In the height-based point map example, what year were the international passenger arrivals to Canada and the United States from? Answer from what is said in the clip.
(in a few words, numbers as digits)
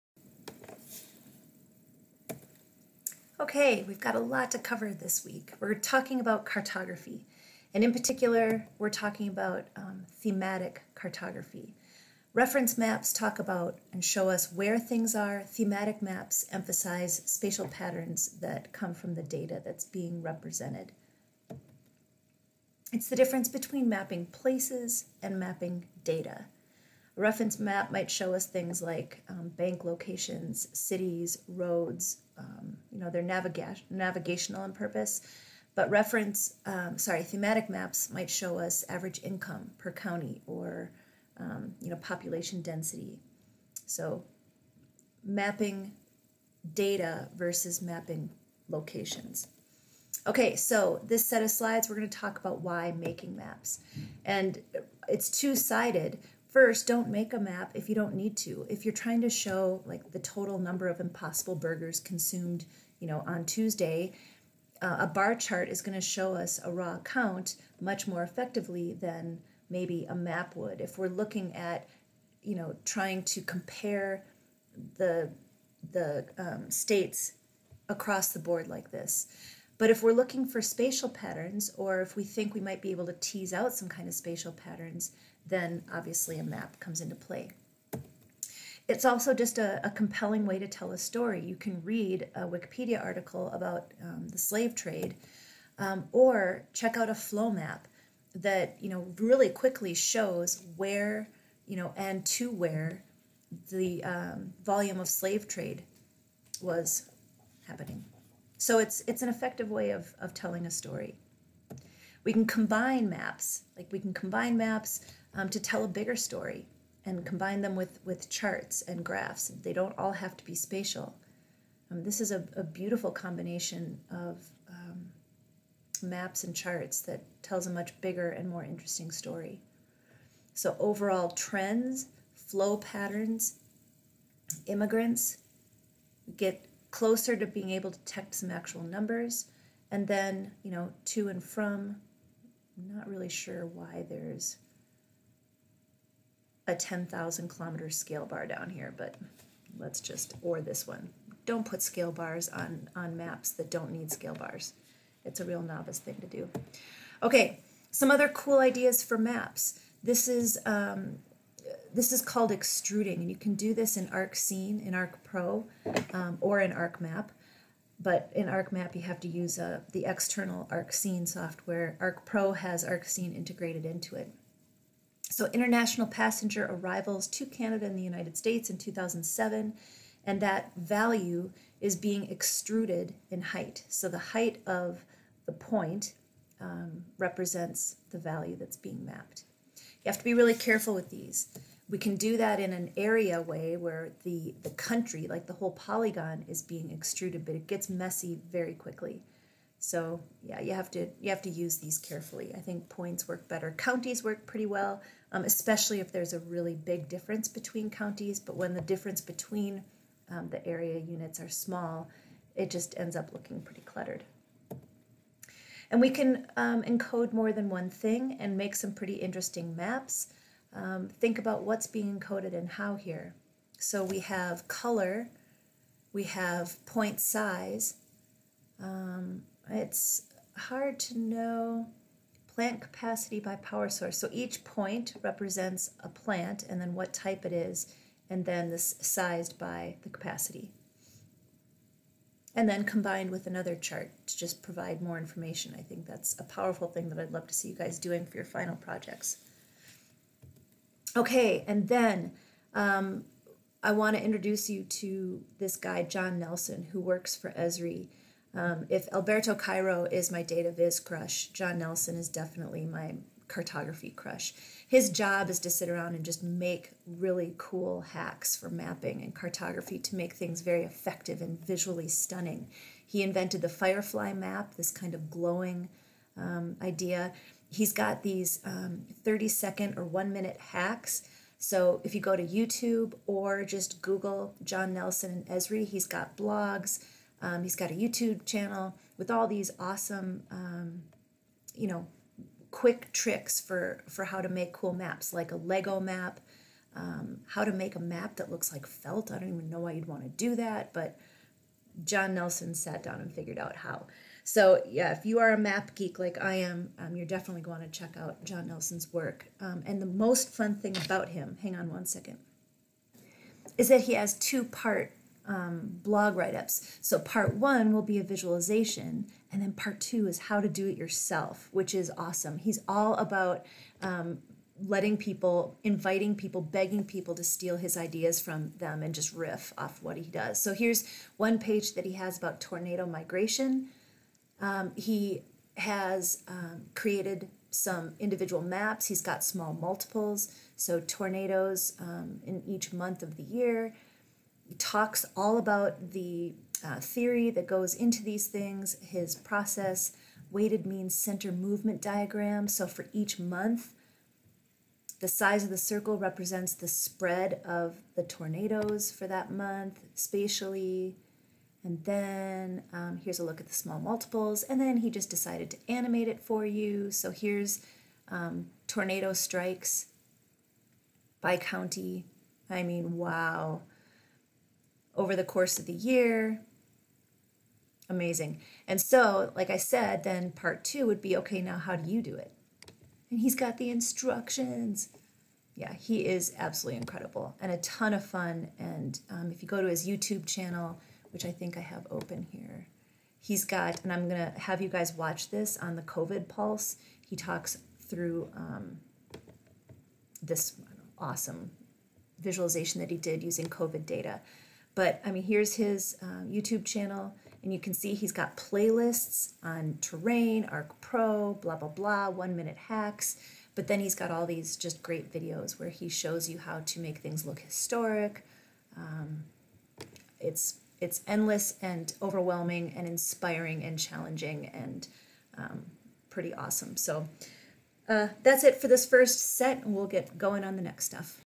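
2007.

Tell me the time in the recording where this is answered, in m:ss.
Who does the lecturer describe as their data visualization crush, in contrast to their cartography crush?
4:19.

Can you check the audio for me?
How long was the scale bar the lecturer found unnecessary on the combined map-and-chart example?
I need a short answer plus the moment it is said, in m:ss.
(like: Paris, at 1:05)
10,000 kilometers, at 2:26.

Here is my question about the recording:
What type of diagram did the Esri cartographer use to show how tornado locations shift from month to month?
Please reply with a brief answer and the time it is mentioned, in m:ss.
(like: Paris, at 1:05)
Weighted mean center movement diagram, at 5:50.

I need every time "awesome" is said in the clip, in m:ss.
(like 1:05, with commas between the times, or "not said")
4:49, 5:22, 6:41, 7:06.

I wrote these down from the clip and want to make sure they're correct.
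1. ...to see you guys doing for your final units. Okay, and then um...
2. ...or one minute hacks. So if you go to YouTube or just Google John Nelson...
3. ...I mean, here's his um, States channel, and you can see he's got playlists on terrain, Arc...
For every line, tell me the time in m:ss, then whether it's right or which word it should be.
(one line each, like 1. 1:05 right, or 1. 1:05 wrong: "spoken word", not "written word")
1. 4:07 wrong: "projects", not "units"
2. 4:39 right
3. 6:45 wrong: "YouTube", not "States".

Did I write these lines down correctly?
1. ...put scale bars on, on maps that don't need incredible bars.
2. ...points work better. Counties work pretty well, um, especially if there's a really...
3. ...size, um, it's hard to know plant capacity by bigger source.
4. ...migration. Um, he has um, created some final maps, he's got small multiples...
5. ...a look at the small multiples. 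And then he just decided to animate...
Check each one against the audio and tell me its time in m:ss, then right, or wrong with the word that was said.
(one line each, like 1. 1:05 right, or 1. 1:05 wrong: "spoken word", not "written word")
1. 2:31 wrong: "scale", not "incredible"
2. 3:22 right
3. 3:47 wrong: "power", not "bigger"
4. 5:33 wrong: "individual", not "final"
5. 6:03 right.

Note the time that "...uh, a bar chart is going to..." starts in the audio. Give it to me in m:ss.
1:04.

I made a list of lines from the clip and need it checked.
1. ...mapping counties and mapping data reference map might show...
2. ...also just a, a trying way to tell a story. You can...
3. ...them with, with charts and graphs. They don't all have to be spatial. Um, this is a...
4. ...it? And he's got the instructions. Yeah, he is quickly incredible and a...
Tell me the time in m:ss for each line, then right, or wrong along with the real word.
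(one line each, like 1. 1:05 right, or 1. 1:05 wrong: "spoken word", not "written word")
1. 0:23 wrong: "places", not "counties"
2. 1:29 wrong: "compelling", not "trying"
3. 1:57 right
4. 6:22 wrong: "absolutely", not "quickly".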